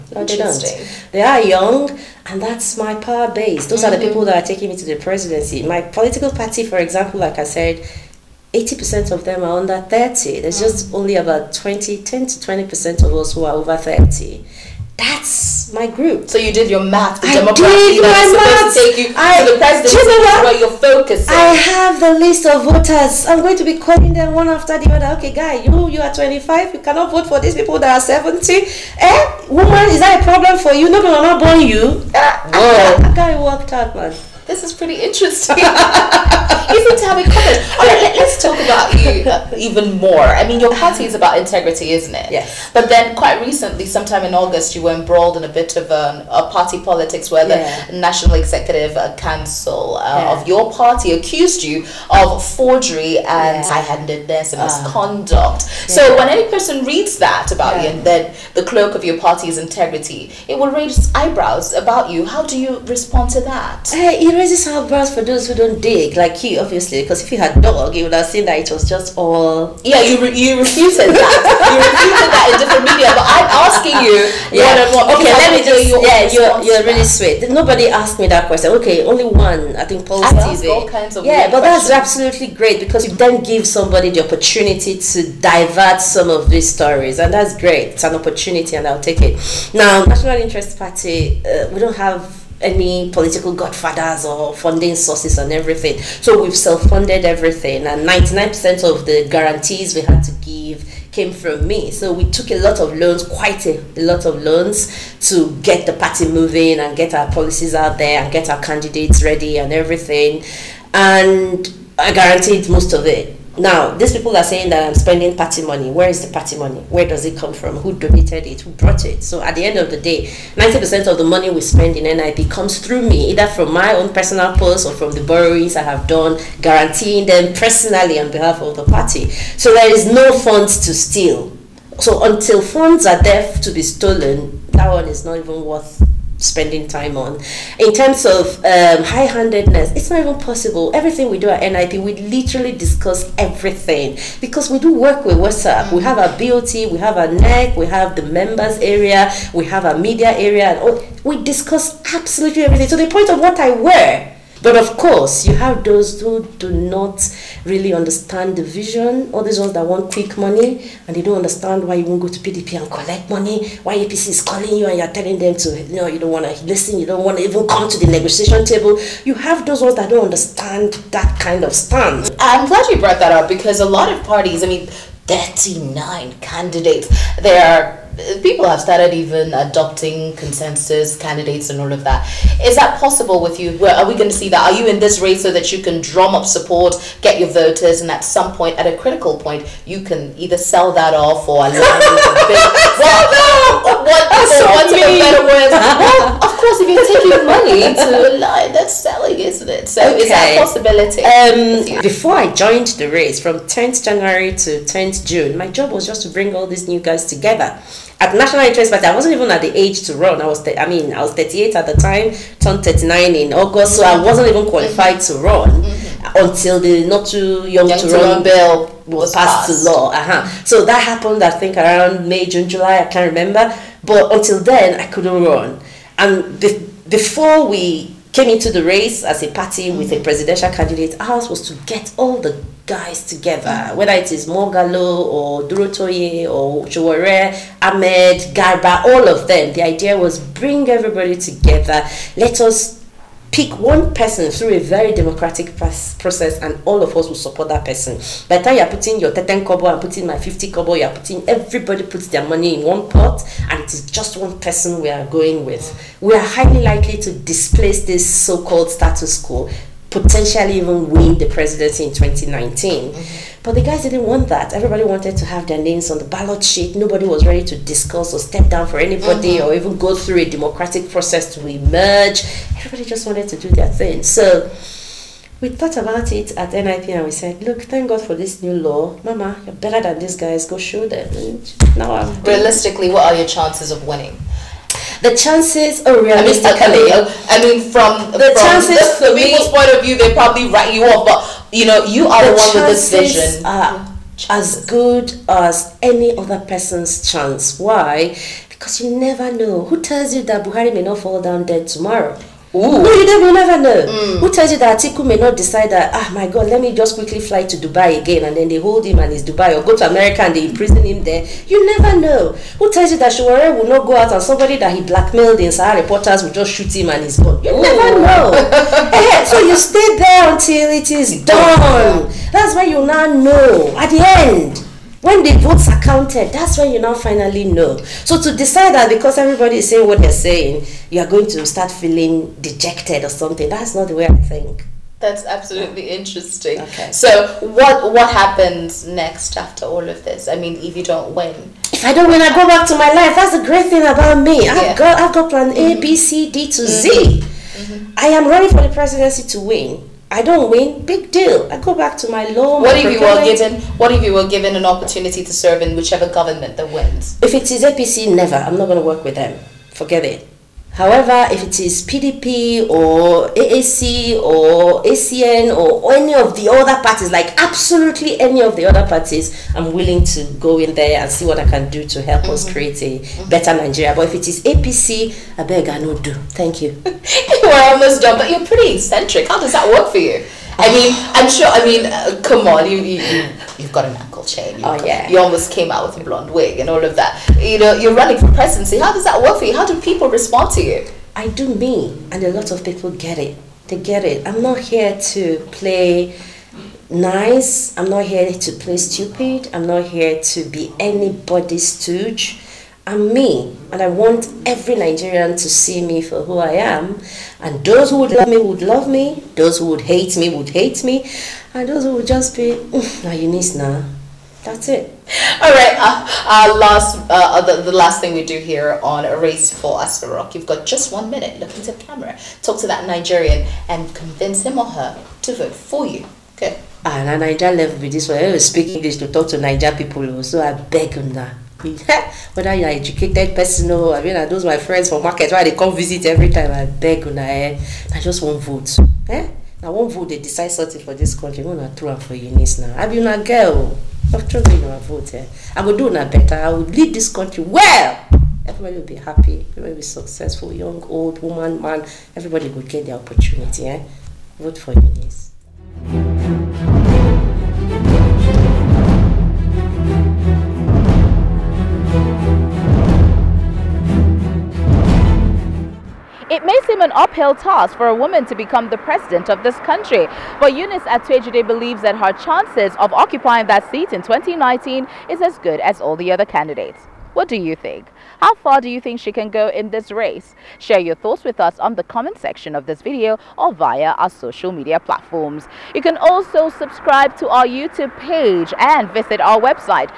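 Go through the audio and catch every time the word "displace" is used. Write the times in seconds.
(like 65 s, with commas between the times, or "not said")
257 s.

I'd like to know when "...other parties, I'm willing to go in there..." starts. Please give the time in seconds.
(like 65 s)
368 s.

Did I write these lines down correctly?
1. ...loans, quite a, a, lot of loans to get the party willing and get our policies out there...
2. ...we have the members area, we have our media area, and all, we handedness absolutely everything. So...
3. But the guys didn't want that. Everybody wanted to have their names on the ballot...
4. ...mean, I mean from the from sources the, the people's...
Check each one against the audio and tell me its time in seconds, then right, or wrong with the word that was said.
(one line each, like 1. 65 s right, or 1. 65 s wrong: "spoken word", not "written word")
1. 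102 s wrong: "moving", not "willing"
2. 147 s wrong: "discuss", not "handedness"
3. 263 s right
4. 287 s wrong: "chances", not "sources".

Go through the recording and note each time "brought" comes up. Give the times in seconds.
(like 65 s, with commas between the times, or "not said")
118 s, 172 s.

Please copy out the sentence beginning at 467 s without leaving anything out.
an uphill task for a woman to become the president of this country.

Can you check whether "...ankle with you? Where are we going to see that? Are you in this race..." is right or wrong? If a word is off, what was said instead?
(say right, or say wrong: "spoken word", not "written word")
wrong: "possible", not "ankle".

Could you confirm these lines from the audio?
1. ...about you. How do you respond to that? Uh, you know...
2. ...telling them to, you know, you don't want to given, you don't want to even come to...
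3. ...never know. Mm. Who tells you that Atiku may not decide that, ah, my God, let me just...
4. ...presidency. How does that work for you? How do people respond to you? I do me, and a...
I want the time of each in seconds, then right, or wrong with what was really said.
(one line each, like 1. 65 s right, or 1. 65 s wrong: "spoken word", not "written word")
1. 61 s right
2. 165 s wrong: "listen", not "given"
3. 303 s right
4. 388 s right.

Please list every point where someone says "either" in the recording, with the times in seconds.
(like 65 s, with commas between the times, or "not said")
123 s, 190 s.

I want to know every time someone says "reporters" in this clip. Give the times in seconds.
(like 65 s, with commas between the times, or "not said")
316 s.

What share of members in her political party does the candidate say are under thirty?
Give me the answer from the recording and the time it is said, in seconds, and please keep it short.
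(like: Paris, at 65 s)
80%, at 8 s.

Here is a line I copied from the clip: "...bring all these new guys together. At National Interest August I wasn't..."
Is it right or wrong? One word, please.
wrong.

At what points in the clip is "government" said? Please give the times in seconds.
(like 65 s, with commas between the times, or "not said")
356 s.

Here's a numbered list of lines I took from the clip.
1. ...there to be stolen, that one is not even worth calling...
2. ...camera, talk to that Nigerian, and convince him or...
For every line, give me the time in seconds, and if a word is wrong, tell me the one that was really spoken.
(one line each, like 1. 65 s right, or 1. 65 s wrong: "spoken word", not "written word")
1. 133 s wrong: "spending", not "calling"
2. 422 s right.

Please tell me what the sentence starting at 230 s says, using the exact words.
presidential candidate, ours was to get all the guys together, mm.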